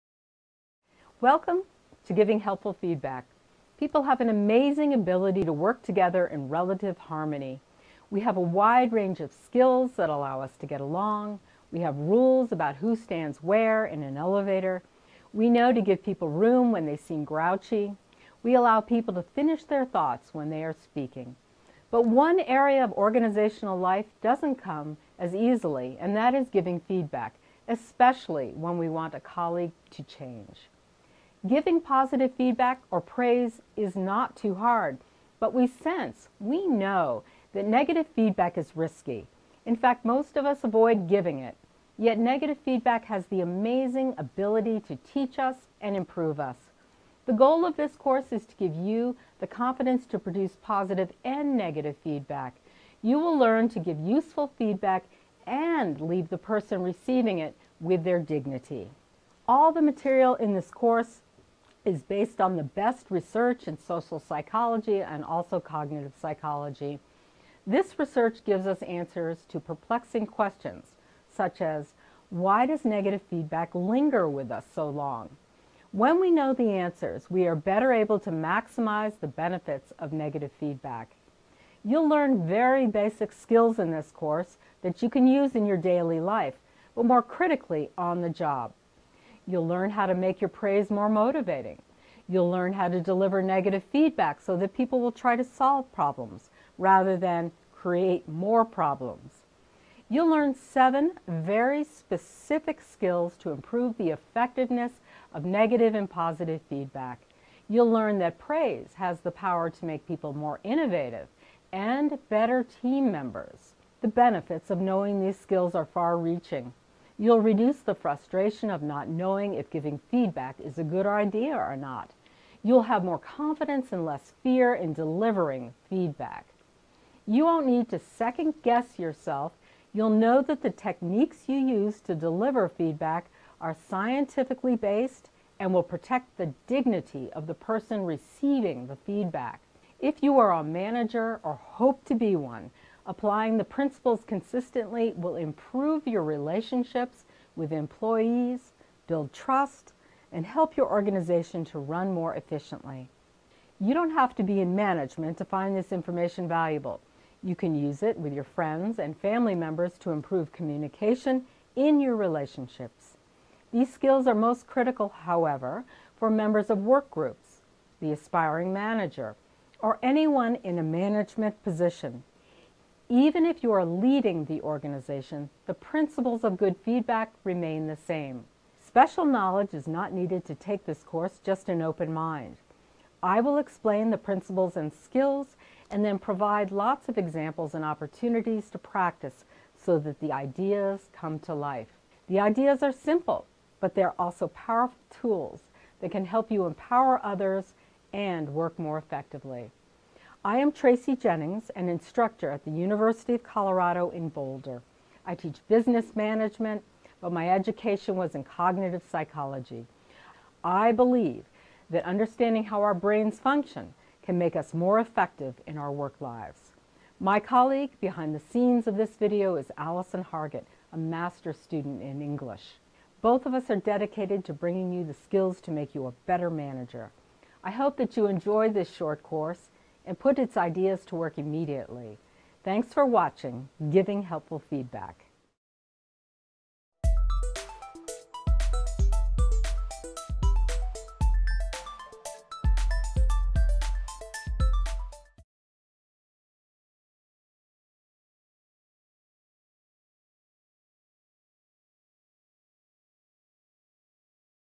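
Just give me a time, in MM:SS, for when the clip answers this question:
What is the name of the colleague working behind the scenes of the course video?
03:39.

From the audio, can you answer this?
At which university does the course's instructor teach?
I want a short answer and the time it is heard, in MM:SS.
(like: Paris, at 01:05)
University of Colorado in Boulder, at 03:22.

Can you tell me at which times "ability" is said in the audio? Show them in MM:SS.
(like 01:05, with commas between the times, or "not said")
00:04, 00:44.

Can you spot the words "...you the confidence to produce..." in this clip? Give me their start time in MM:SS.
00:48.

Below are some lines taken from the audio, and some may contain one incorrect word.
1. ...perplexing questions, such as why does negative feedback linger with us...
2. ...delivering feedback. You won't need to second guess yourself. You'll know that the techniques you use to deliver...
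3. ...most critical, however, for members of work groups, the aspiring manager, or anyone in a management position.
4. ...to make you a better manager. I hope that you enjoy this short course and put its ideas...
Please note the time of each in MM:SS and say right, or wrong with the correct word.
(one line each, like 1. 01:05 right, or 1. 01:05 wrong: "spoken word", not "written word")
1. 01:09 right
2. 02:04 right
3. 02:44 right
4. 03:45 right.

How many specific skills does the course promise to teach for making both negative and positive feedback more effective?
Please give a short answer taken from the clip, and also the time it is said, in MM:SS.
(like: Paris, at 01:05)
7, at 01:40.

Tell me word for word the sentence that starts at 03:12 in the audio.
The ideas are simple, but they're also powerful tools that can help you empower others and work more effectively.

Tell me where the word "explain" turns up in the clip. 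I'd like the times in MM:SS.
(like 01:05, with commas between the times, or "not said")
03:03.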